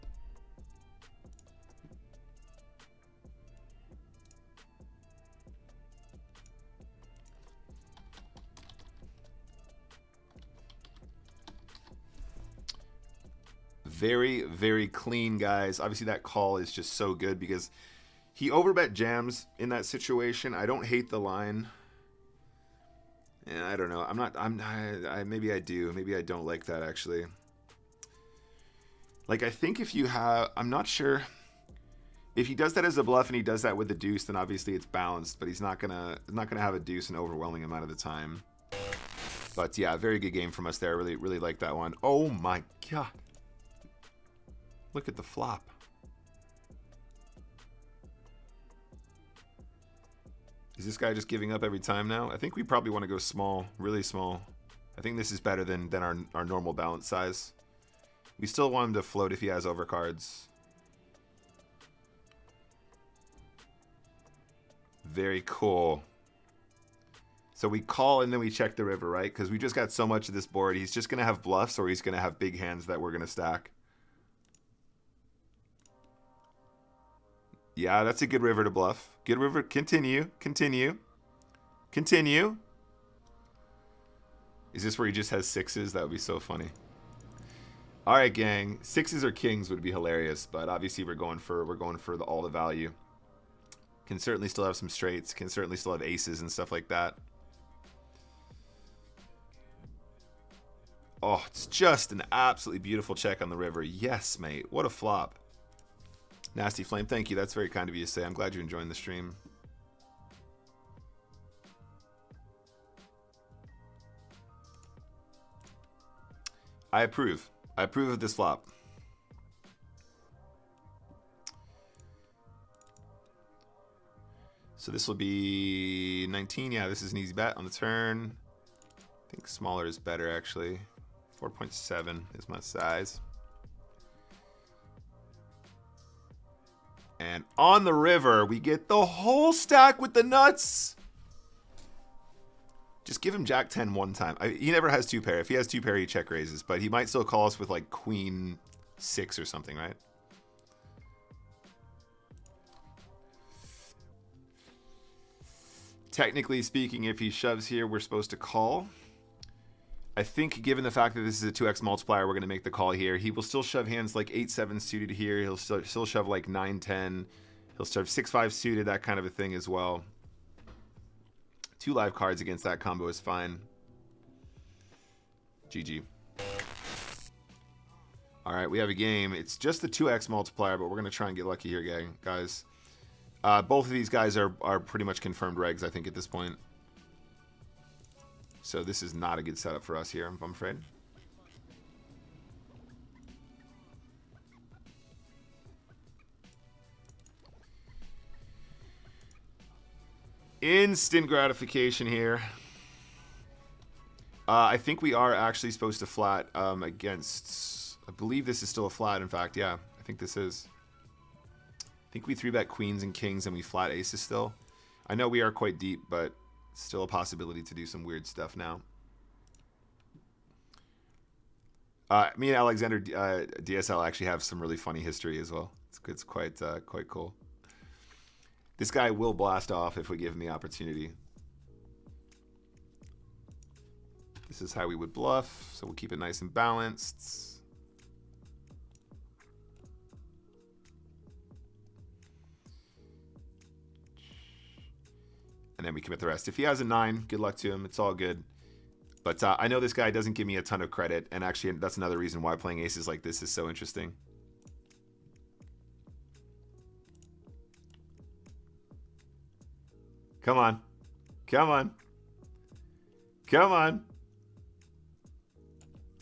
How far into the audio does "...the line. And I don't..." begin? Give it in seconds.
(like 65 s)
21 s.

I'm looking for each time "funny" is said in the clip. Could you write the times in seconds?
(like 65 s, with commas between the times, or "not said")
86 s, 224 s.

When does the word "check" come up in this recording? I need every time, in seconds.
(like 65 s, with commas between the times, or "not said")
68 s, 103 s, 146 s.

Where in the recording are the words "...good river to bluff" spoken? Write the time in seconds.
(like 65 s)
78 s.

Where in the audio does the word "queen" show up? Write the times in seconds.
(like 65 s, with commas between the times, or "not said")
147 s, 212 s.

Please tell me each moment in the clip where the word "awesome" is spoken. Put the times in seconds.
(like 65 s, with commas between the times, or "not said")
not said.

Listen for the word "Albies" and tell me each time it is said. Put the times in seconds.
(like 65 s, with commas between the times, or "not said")
not said.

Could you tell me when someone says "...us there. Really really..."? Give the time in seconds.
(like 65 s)
40 s.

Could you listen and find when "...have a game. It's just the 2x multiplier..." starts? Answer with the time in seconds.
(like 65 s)
178 s.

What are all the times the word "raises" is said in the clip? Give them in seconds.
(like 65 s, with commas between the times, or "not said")
146 s.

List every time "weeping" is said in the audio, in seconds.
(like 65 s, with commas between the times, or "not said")
not said.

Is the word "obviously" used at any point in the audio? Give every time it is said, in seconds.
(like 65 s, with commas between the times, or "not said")
15 s, 34 s, 90 s.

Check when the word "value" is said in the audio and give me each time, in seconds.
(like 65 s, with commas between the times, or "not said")
92 s.